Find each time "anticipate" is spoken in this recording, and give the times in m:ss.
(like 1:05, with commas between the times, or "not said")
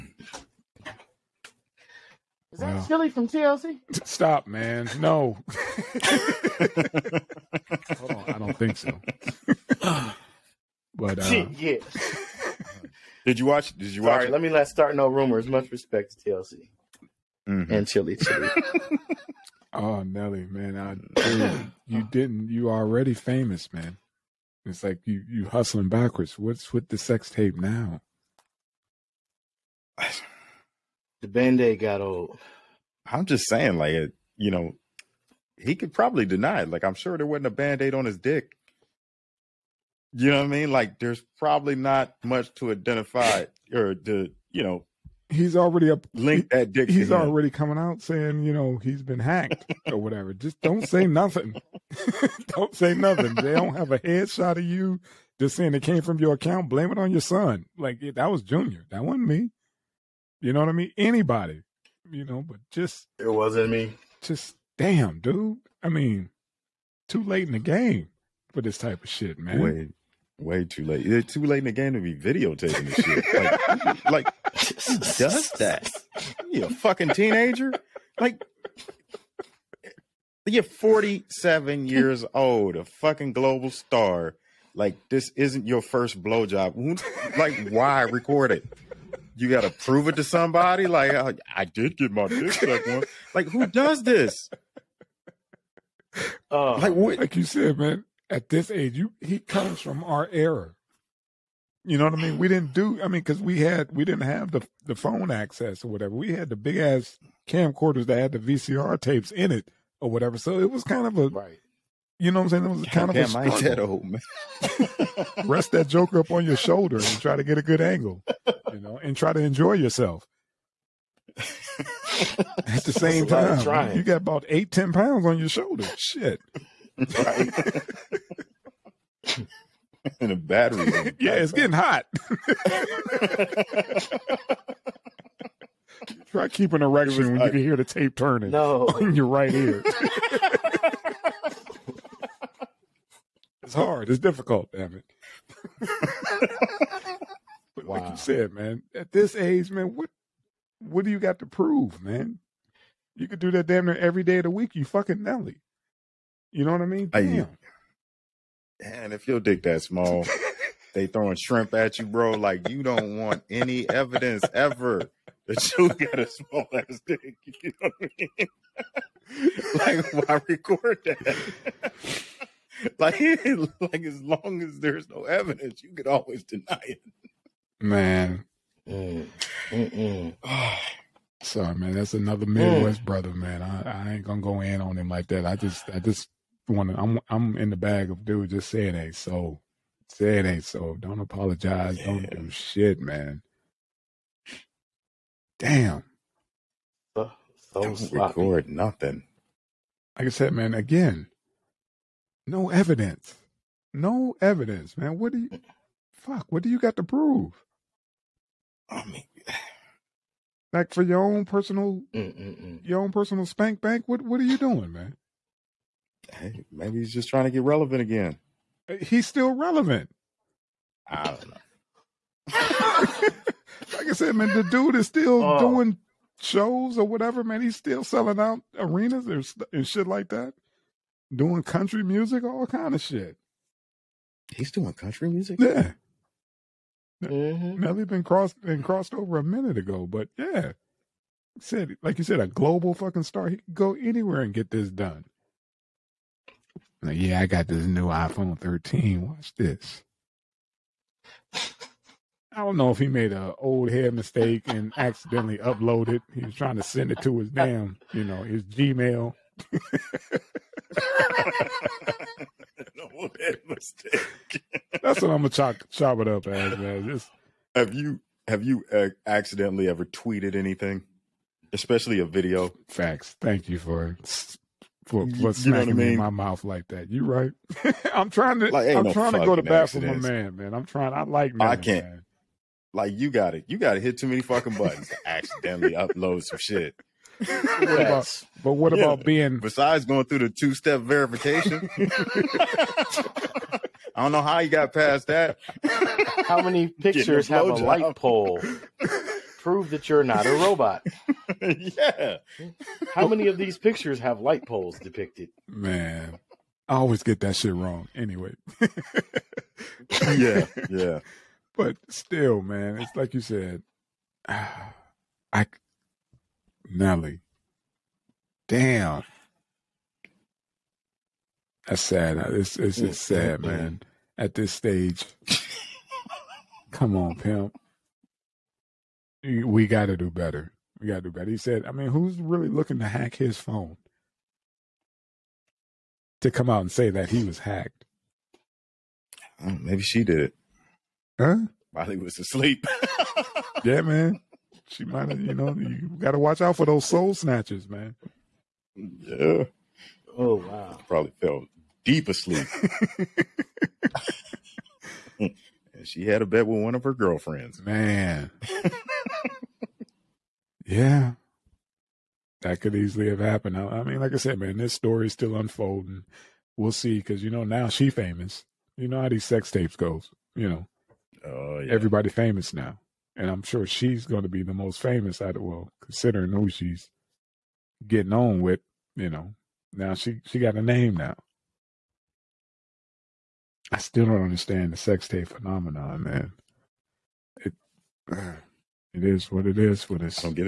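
not said.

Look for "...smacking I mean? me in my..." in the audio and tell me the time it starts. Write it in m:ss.
4:35.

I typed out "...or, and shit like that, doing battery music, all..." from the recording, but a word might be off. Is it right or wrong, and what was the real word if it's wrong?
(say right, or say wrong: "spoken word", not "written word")
wrong: "country", not "battery".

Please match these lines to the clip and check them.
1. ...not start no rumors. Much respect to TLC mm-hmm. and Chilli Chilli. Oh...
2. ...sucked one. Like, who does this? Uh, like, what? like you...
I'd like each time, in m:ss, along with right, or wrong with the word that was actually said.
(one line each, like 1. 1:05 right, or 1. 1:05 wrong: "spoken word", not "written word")
1. 0:14 right
2. 1:32 right.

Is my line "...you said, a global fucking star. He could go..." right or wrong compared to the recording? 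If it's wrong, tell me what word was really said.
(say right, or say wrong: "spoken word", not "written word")
right.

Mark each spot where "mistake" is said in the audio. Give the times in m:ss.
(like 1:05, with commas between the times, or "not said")
4:14, 4:23.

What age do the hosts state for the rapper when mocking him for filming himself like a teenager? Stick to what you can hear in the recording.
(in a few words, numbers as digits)
47.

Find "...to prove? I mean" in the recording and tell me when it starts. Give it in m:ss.
3:26.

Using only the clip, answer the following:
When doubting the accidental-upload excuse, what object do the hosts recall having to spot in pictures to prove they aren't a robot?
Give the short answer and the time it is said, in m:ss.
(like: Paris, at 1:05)
light pole, at 4:57.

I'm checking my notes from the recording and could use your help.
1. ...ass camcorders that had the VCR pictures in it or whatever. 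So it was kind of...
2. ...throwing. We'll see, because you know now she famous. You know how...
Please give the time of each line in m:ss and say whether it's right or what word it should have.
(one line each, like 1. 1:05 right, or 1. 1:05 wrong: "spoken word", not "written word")
1. 1:46 wrong: "tapes", not "pictures"
2. 6:05 wrong: "unfolding", not "throwing".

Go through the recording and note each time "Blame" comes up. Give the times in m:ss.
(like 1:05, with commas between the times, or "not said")
0:56.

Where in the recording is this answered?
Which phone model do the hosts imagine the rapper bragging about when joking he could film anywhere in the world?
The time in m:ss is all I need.
4:08.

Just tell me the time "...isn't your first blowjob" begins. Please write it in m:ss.
1:25.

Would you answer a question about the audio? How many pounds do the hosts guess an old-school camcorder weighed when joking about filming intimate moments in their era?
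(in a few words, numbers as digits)
eight, ten.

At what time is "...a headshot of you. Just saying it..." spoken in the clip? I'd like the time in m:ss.
0:53.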